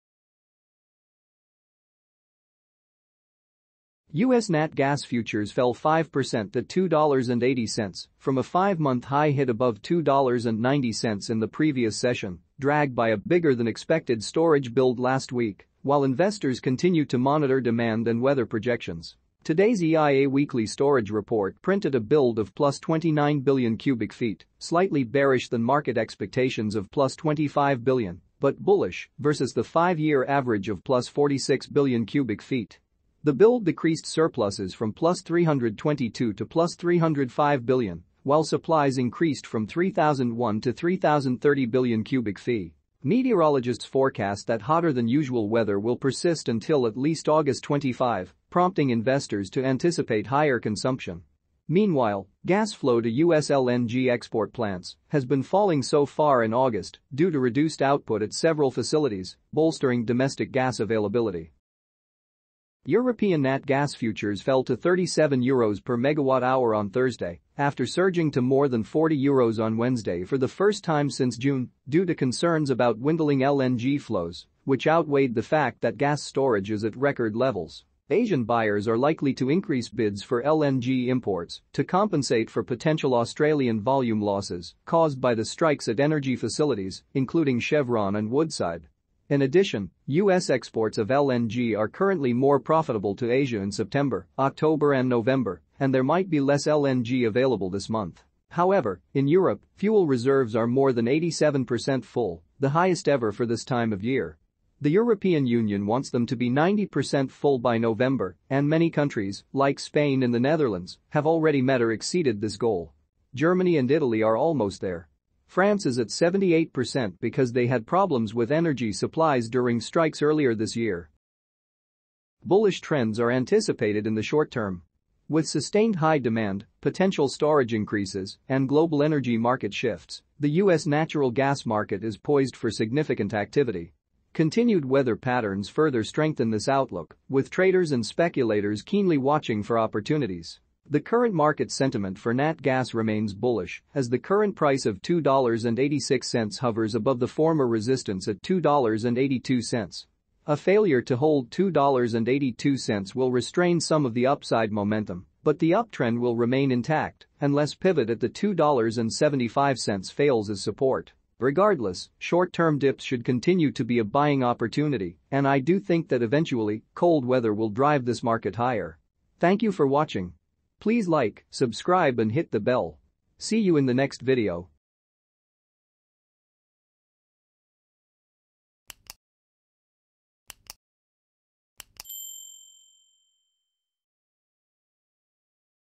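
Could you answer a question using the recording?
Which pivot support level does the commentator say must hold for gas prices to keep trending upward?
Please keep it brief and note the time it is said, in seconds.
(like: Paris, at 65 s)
$2.75, at 158 s.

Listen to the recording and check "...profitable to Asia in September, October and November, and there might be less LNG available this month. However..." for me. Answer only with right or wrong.
right.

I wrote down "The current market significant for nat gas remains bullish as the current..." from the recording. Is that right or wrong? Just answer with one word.
wrong.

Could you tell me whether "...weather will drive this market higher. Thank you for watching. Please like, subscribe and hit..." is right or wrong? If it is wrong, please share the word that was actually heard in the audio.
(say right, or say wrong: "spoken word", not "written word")
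right.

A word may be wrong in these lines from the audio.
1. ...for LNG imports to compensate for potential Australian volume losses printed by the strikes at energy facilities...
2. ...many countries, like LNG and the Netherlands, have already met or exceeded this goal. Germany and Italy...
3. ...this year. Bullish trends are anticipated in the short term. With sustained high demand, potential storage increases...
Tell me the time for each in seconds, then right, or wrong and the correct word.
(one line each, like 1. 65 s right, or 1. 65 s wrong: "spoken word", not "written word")
1. 80 s wrong: "caused", not "printed"
2. 108 s wrong: "Spain", not "LNG"
3. 120 s right.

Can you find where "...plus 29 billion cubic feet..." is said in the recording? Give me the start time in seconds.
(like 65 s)
22 s.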